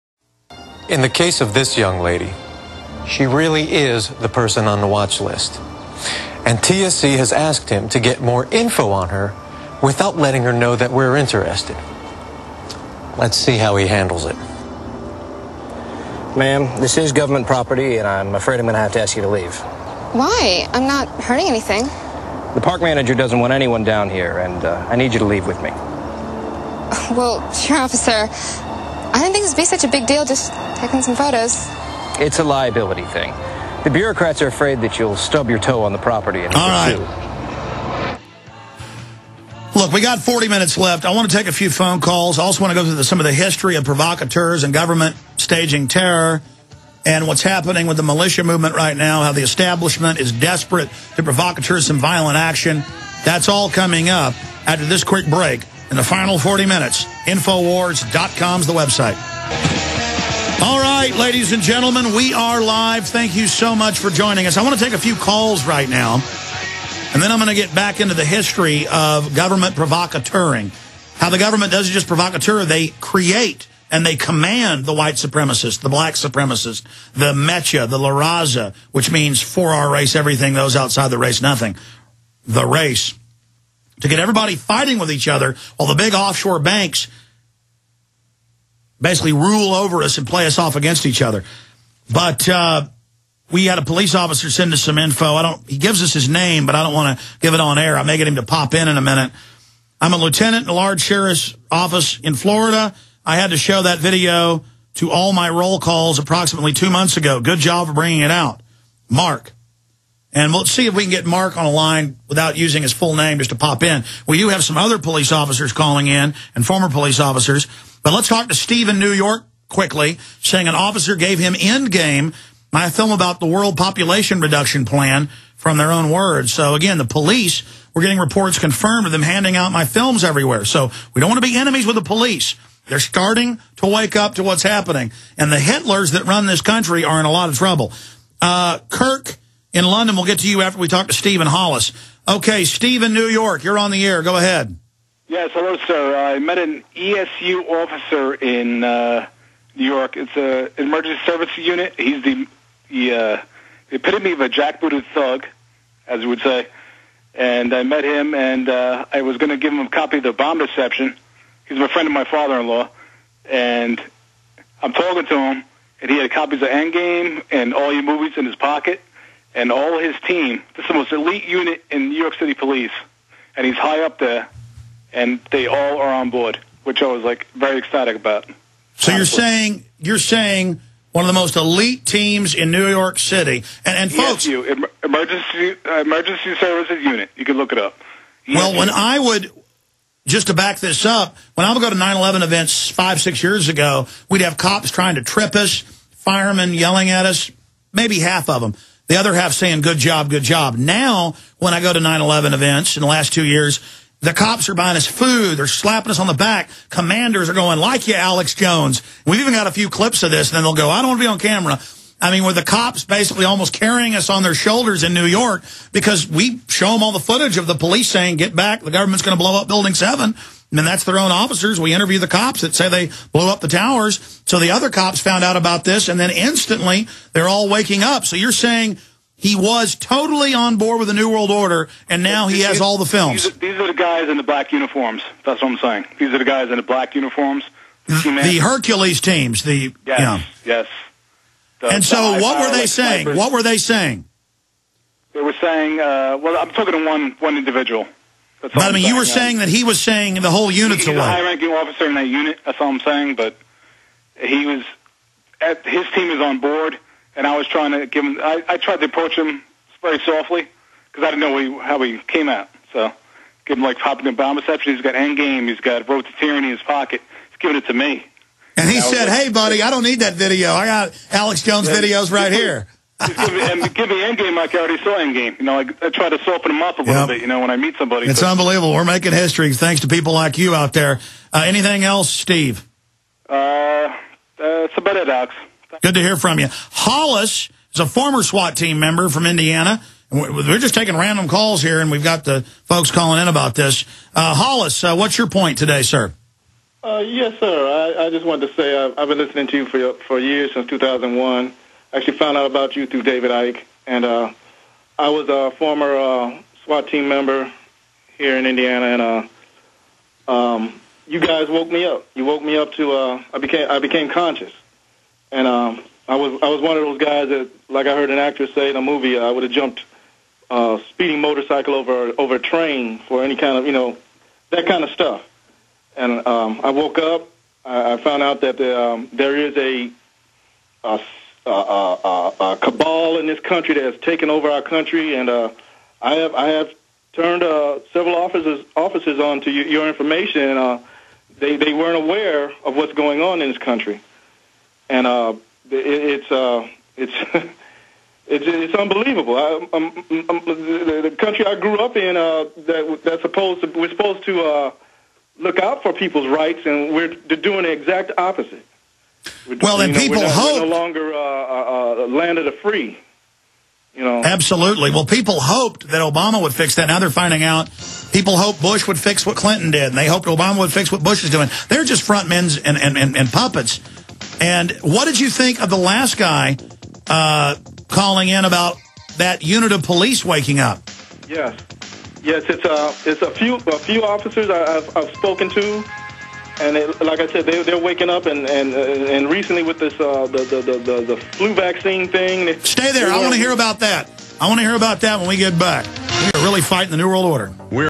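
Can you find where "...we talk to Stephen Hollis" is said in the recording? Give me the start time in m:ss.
2:20.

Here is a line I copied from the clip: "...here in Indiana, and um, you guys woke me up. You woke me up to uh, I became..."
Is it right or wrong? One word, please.
right.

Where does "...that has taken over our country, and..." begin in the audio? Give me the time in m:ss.
5:33.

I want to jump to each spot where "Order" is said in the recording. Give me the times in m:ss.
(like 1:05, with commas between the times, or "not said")
3:51, 6:37.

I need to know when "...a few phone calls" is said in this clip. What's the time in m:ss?
0:41.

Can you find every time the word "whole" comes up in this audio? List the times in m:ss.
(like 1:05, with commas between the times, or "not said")
4:10.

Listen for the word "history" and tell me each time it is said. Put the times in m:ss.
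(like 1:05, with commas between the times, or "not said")
0:43, 1:08, 4:39.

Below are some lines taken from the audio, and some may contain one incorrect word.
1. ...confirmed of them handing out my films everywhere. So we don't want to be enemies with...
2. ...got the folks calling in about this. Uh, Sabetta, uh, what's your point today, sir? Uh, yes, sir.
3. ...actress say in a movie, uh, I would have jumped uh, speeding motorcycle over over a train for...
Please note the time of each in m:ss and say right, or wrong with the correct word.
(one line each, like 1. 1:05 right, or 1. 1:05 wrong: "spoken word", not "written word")
1. 2:08 right
2. 4:52 wrong: "Hollis", not "Sabetta"
3. 5:18 right.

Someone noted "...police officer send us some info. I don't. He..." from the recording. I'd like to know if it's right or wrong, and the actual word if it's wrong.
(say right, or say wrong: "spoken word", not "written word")
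right.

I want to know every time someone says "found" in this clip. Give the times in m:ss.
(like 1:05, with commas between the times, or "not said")
3:45, 5:02, 5:28.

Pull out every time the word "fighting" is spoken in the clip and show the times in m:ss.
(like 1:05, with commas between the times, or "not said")
1:24, 6:36.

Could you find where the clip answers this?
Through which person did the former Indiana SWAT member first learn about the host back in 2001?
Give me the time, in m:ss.
5:03.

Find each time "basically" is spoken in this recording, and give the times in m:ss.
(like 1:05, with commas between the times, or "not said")
1:28, 3:33.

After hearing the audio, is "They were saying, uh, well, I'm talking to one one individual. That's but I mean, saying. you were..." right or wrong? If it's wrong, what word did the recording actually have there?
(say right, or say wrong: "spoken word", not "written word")
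right.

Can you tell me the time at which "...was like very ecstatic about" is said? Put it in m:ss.
2:57.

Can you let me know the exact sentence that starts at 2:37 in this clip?
And I met him, and uh, I was going to give him a copy of The Obama Deception.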